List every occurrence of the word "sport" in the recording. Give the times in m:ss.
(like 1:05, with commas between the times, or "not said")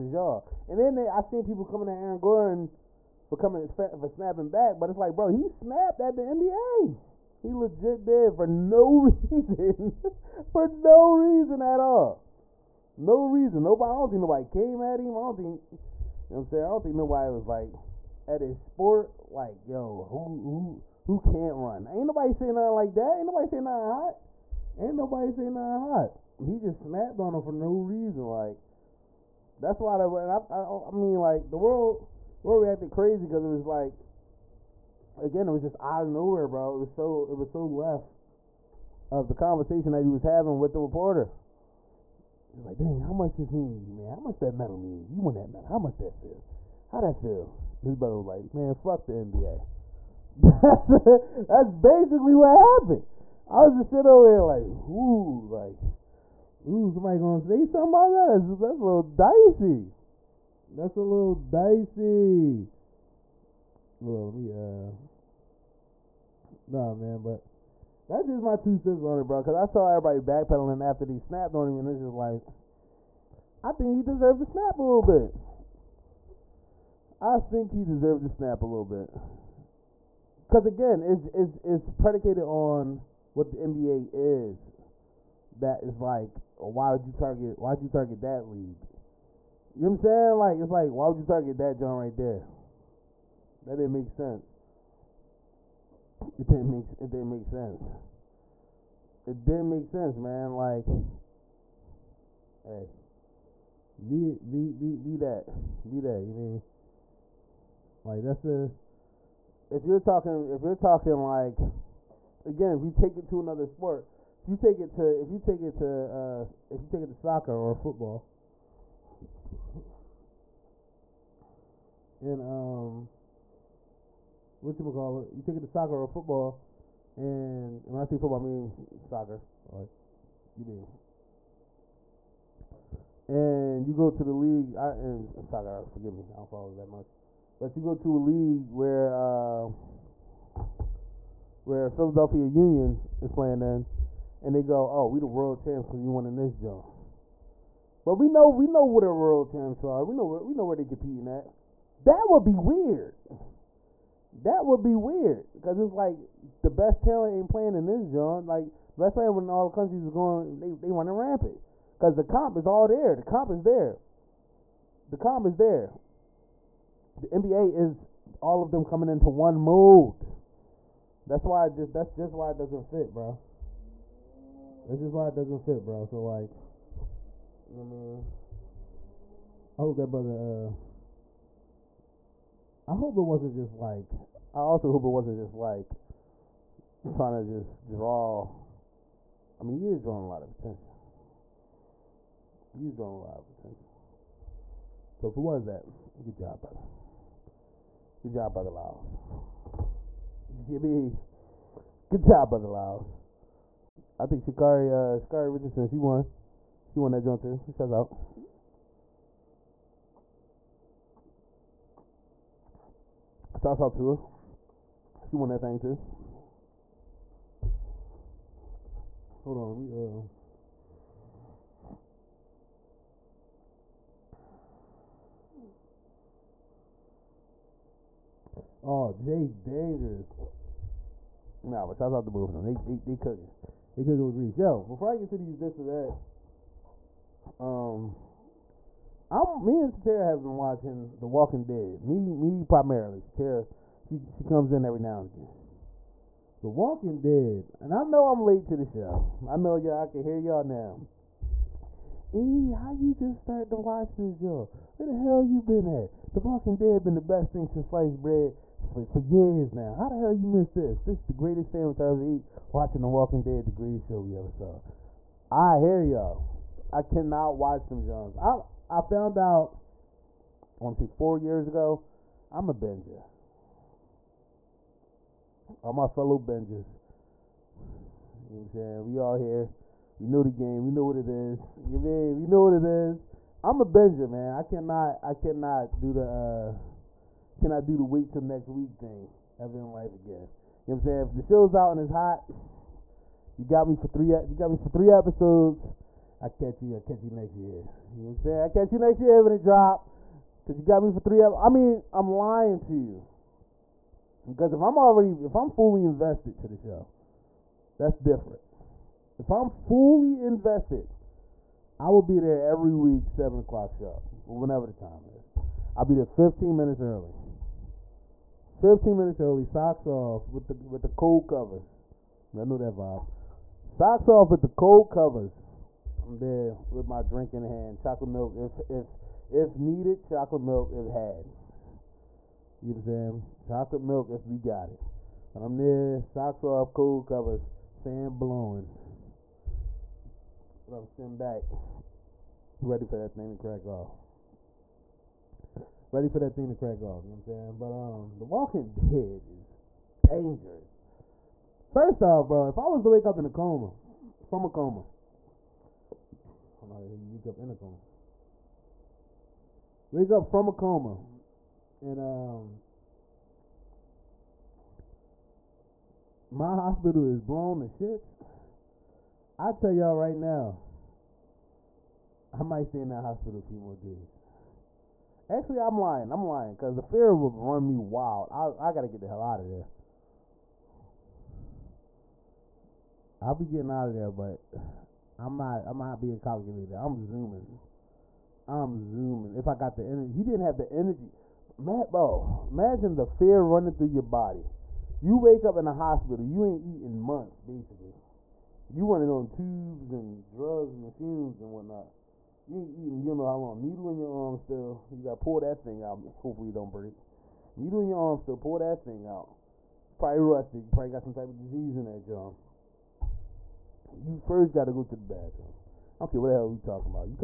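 0:18, 1:53.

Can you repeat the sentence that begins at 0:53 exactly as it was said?
I was just sitting over here like, ooh, like, ooh, somebody gonna say something about that?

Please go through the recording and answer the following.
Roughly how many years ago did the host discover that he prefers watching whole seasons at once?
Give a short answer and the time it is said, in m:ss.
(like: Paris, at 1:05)
4, at 4:31.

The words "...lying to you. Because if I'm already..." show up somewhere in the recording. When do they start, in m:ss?
5:02.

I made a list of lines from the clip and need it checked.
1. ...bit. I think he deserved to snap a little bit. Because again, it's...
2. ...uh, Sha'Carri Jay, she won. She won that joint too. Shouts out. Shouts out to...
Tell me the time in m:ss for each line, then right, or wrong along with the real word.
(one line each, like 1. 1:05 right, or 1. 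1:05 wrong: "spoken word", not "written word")
1. 1:15 right
2. 3:24 wrong: "Richardson", not "Jay".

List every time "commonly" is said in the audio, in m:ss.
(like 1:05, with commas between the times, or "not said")
not said.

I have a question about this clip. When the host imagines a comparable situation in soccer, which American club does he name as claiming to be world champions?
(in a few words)
Philadelphia Union.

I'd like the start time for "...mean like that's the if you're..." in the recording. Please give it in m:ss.
1:46.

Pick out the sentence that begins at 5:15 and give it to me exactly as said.
I'll be there 15 minutes early.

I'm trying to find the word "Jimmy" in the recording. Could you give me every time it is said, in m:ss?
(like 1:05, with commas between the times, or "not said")
3:20.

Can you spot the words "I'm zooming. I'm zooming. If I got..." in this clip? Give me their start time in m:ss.
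6:26.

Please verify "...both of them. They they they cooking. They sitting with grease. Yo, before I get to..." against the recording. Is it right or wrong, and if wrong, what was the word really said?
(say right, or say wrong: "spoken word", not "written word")
wrong: "cooking", not "sitting".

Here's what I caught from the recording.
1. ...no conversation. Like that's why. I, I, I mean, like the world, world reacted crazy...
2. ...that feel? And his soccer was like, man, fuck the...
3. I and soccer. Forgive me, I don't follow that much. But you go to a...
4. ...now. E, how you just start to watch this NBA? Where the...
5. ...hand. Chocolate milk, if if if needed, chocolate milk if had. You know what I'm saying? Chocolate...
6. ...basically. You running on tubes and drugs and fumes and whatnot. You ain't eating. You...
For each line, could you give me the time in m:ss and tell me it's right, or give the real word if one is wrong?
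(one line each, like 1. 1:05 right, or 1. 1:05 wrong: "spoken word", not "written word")
1. 0:27 wrong: "reason", not "conversation"
2. 0:47 wrong: "brother", not "soccer"
3. 2:14 right
4. 4:10 wrong: "Joe", not "NBA"
5. 5:27 right
6. 6:37 right.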